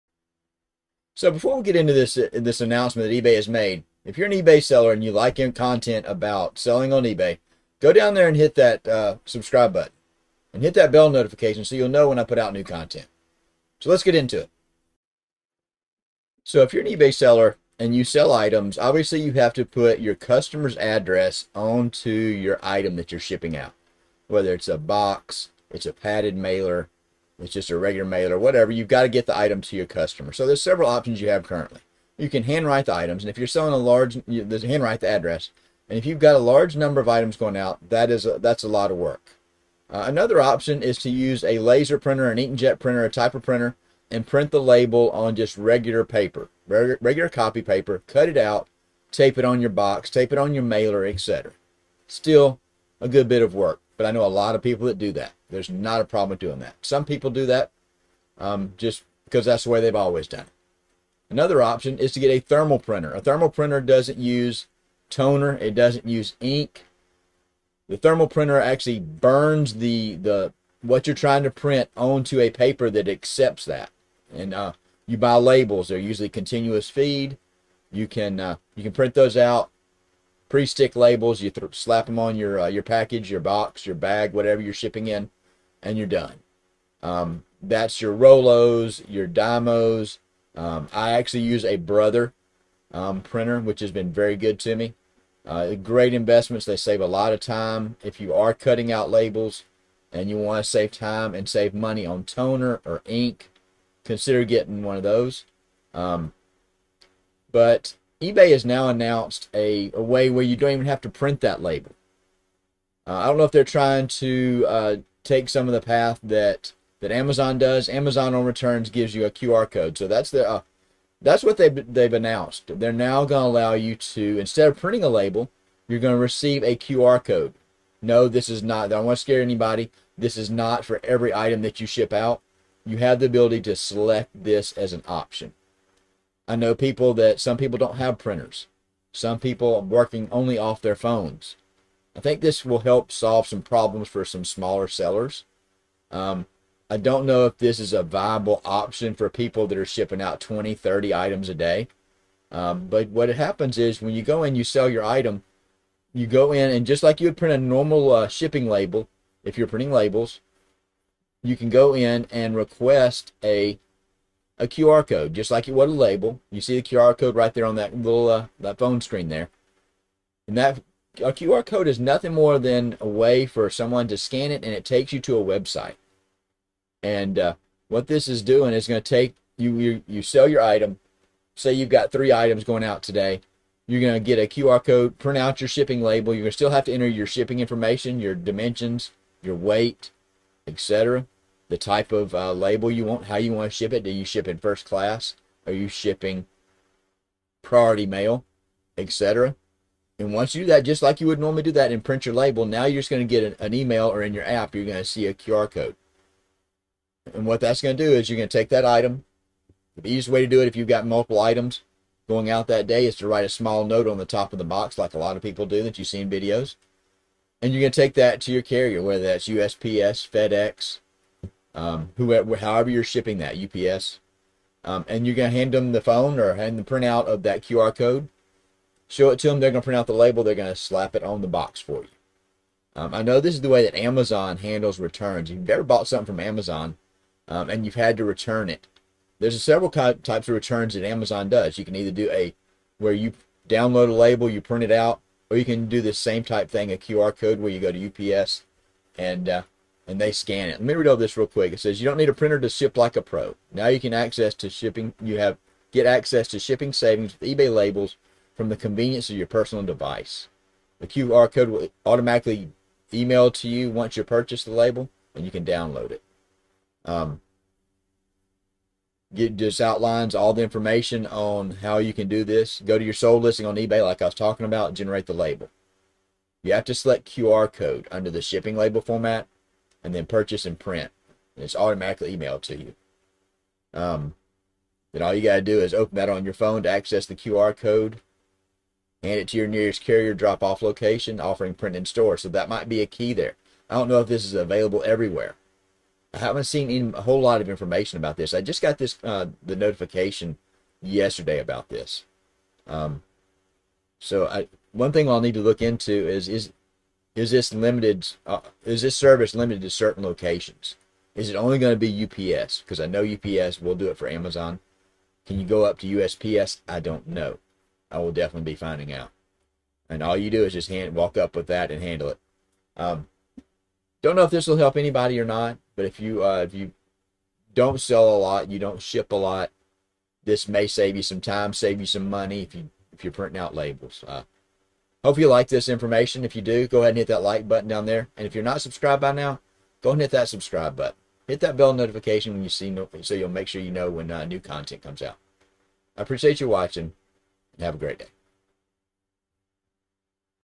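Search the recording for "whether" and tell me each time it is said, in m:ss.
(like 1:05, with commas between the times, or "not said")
0:24, 3:39.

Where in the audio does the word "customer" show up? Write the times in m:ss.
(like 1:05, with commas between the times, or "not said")
0:20, 0:29.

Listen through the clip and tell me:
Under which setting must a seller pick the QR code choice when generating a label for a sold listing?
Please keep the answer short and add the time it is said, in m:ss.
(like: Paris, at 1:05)
shipping label format, at 4:38.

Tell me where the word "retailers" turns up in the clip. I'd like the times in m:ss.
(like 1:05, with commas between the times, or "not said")
not said.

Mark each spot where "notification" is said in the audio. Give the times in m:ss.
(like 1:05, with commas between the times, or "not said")
0:11, 4:59, 5:41.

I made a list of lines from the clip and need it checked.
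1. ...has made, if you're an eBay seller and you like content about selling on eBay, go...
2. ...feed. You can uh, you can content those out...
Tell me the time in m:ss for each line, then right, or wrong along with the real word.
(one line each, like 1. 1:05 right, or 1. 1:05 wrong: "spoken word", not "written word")
1. 0:03 right
2. 1:16 wrong: "print", not "content".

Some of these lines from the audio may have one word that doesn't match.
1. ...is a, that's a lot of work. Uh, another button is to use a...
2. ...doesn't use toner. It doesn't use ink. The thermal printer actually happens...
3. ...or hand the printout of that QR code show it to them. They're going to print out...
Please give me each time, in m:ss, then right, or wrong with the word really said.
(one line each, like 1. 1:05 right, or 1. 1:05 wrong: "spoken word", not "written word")
1. 0:38 wrong: "option", not "button"
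2. 1:03 wrong: "burns", not "happens"
3. 3:46 right.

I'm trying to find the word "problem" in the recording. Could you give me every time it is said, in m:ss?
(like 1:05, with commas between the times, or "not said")
0:56, 2:23.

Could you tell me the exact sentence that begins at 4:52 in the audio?
So that might be a key there.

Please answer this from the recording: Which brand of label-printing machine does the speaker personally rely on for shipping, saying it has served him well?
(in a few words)
Brother.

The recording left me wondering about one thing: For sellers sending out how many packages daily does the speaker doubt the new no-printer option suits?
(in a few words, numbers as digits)
20, 30.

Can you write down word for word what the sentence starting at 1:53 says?
Uh, I don't know if they're trying to uh, take some of the path that that Amazon does.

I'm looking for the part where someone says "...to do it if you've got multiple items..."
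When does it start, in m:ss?
3:30.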